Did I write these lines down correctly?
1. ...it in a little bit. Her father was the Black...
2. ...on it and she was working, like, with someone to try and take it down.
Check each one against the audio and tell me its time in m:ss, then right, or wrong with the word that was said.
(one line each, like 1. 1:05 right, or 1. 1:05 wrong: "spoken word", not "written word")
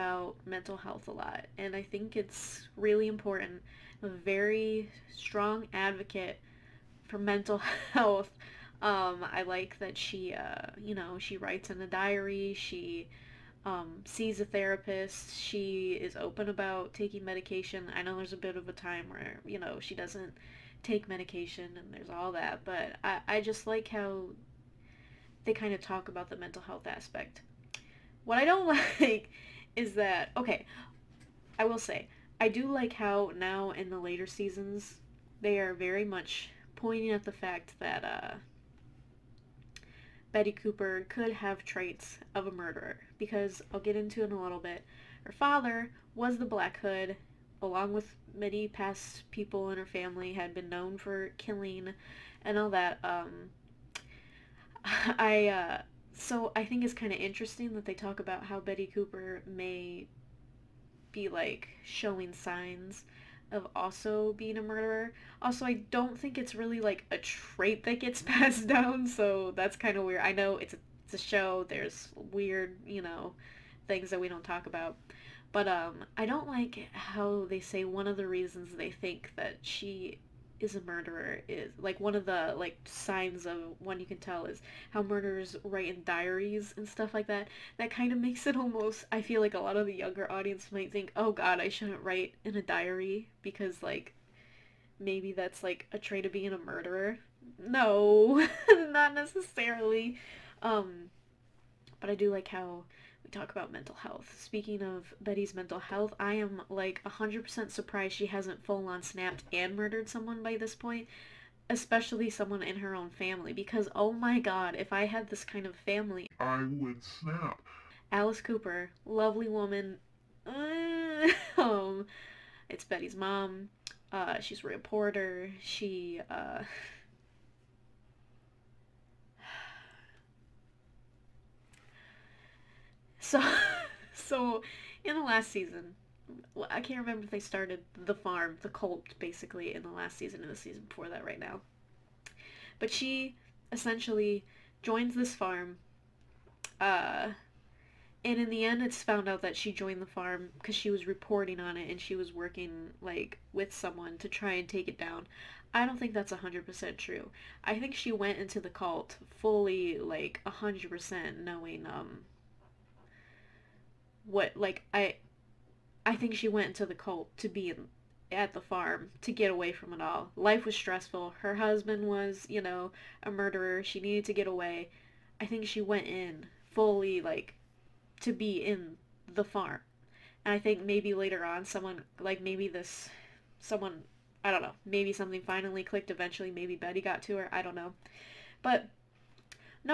1. 0:44 right
2. 2:31 right.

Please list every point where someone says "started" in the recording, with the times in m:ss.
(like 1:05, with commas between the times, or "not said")
2:17.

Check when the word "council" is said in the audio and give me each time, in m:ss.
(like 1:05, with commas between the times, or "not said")
not said.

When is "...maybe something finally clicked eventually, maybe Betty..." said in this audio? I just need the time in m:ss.
3:04.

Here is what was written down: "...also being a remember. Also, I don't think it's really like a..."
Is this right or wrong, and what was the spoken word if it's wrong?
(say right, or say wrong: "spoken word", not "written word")
wrong: "murderer", not "remember".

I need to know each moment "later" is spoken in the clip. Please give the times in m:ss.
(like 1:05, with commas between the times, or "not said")
0:33, 3:01.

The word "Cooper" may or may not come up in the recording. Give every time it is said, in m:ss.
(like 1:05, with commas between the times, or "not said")
0:40, 0:58, 1:58.